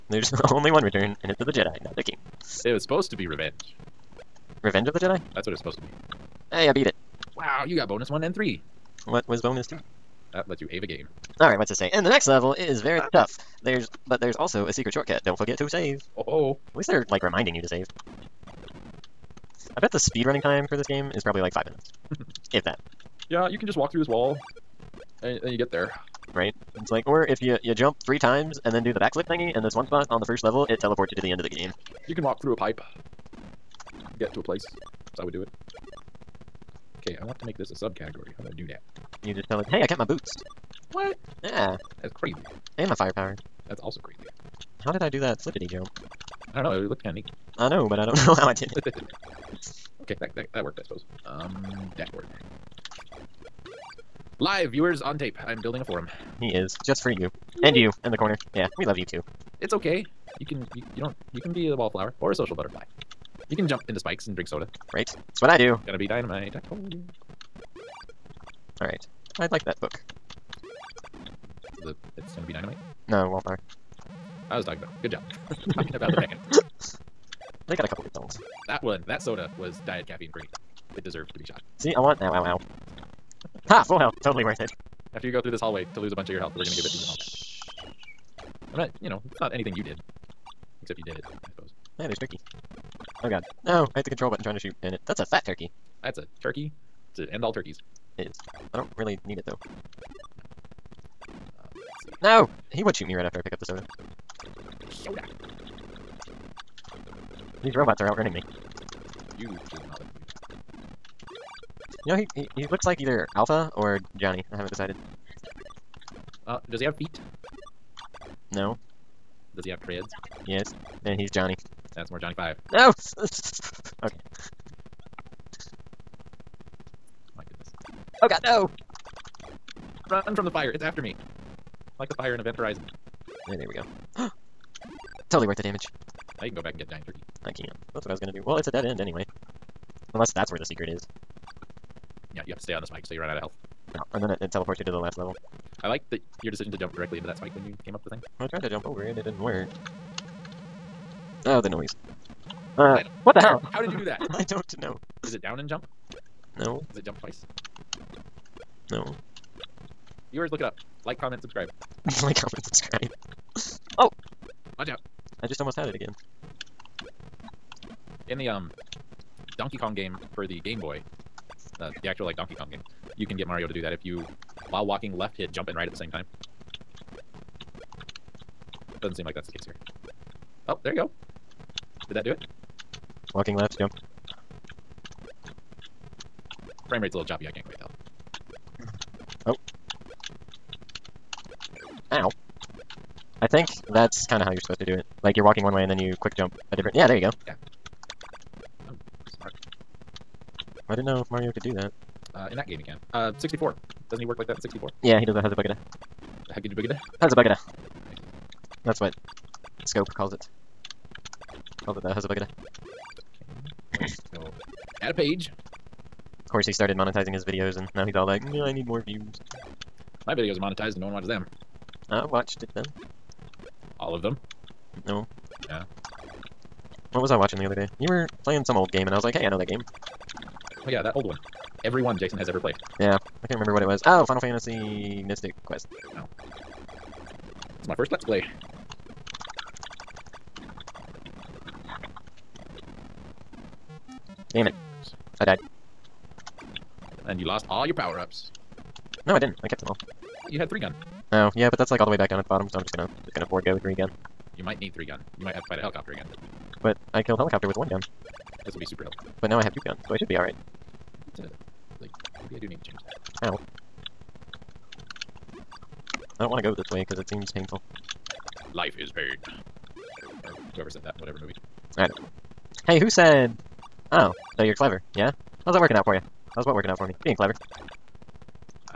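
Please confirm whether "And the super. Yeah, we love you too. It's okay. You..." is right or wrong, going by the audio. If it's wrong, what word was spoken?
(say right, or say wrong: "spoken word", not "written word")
wrong: "corner", not "super".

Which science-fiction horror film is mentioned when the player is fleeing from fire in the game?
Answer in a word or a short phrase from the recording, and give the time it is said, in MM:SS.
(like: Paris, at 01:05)
Event Horizon, at 02:12.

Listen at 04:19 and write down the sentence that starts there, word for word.
But now I have two guns, so I should be alright.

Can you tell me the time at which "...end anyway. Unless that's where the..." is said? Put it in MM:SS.
02:18.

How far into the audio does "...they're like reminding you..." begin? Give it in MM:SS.
00:16.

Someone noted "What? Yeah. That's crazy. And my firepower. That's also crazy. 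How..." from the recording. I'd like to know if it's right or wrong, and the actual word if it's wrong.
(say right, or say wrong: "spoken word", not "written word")
right.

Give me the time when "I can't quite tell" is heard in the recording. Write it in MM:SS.
03:07.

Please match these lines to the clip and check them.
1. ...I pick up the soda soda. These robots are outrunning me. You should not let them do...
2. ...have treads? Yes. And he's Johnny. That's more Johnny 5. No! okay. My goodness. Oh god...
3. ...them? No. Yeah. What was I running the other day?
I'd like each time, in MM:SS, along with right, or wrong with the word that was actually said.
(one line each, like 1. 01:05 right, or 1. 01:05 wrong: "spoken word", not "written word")
1. 01:43 right
2. 01:59 right
3. 03:44 wrong: "watching", not "running".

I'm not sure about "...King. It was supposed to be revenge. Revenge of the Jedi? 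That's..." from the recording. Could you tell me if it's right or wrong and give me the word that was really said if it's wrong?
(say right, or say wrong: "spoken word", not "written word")
right.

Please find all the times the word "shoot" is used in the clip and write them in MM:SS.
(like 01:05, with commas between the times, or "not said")
01:34, 01:42.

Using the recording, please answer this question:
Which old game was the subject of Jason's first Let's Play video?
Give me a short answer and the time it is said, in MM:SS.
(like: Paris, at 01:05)
Final Fantasy Mystic Quest, at 03:54.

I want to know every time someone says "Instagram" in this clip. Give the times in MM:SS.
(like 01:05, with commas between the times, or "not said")
not said.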